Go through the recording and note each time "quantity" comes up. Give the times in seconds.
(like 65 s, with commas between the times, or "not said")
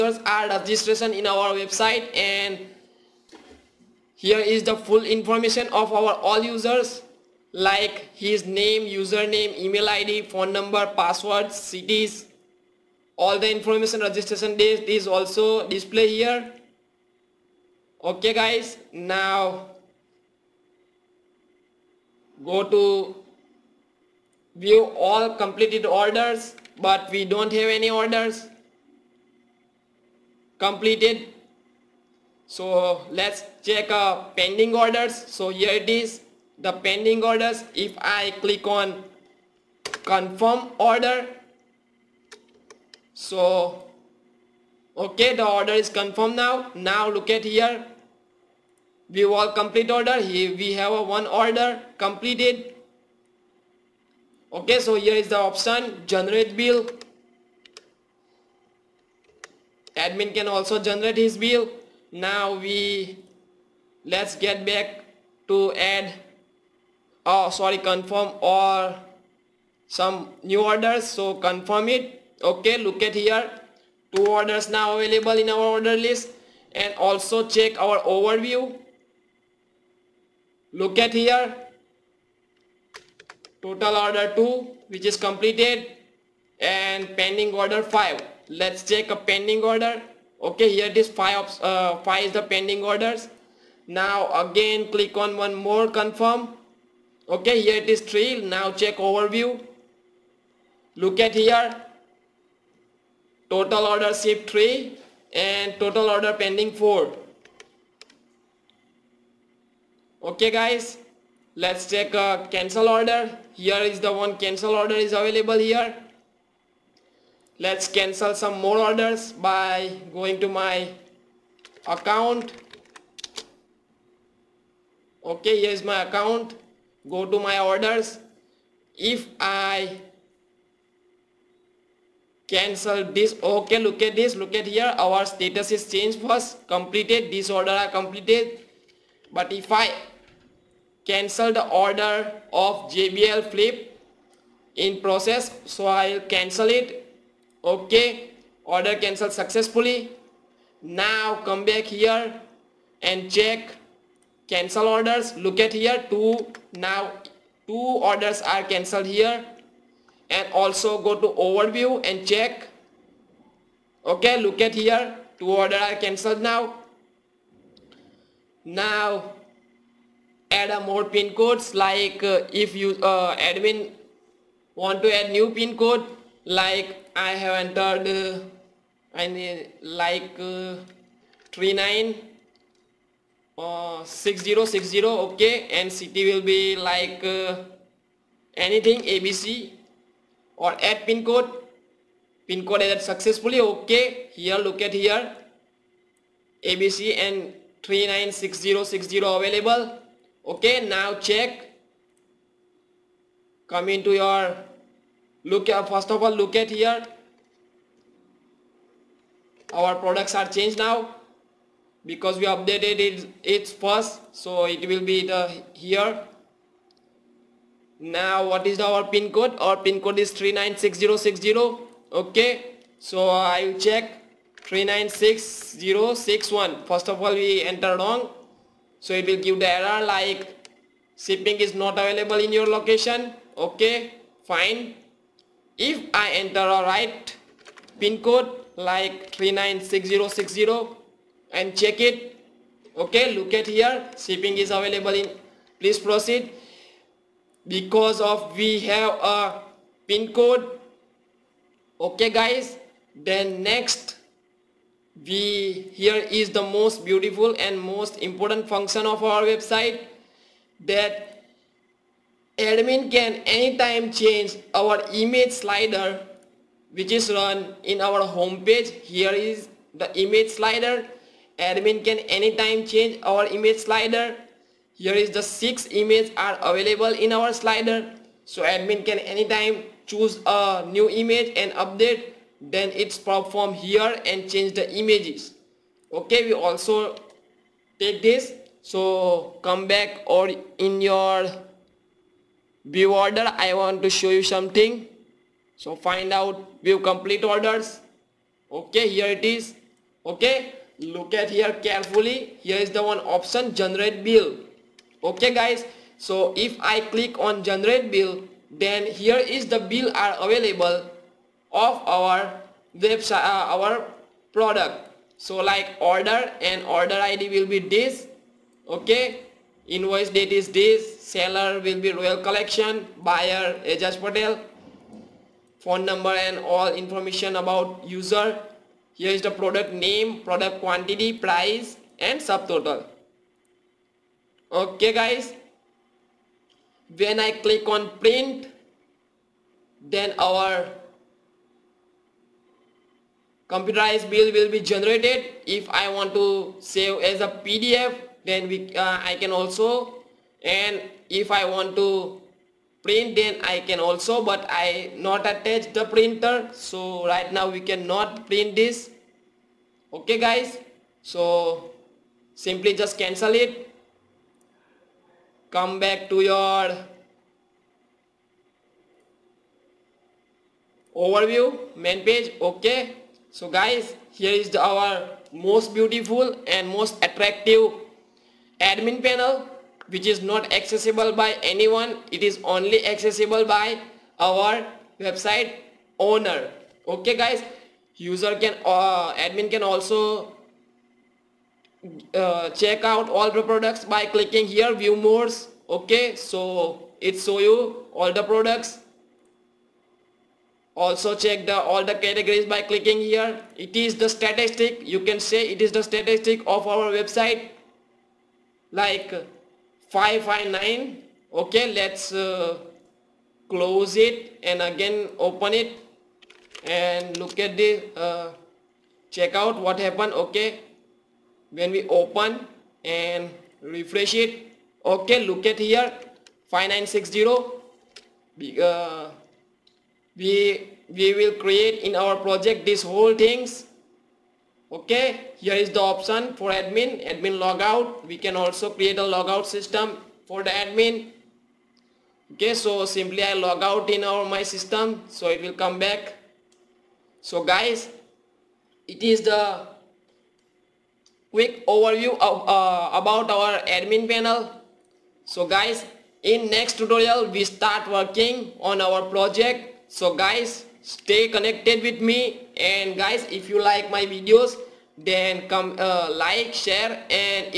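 330 s.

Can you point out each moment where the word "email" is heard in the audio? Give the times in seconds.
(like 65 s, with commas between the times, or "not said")
9 s.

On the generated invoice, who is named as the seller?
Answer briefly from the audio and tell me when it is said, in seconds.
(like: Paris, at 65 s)
Royal Collection, at 322 s.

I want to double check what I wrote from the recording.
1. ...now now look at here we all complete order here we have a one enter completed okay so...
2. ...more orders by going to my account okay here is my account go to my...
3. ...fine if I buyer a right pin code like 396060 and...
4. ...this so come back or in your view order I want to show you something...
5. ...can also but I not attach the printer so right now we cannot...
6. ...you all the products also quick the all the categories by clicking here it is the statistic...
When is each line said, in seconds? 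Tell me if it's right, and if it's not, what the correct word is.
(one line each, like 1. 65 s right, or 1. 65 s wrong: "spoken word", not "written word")
1. 46 s wrong: "order", not "enter"
2. 118 s right
3. 234 s wrong: "enter", not "buyer"
4. 288 s right
5. 353 s right
6. 397 s wrong: "check", not "quick".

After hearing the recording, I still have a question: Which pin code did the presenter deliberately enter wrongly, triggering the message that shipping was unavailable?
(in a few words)
396061.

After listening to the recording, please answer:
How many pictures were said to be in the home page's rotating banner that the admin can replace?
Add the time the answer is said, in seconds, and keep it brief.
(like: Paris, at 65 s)
6, at 275 s.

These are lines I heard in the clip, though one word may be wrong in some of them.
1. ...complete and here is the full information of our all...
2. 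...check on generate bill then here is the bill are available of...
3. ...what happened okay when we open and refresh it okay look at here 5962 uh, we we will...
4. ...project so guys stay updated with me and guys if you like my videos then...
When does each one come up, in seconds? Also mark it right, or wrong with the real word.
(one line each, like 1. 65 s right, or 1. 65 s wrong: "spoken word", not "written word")
1. 1 s wrong: "website", not "complete"
2. 307 s wrong: "click", not "check"
3. 419 s wrong: "5960", not "5962"
4. 459 s wrong: "connected", not "updated".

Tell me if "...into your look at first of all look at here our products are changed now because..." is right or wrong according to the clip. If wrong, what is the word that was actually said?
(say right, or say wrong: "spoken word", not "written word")
right.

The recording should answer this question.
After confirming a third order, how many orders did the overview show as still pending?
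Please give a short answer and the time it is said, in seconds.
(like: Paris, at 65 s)
4, at 106 s.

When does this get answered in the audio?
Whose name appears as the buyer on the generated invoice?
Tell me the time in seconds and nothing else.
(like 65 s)
323 s.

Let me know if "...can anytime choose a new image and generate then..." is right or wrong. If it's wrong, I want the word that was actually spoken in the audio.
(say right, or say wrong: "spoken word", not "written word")
wrong: "update", not "generate".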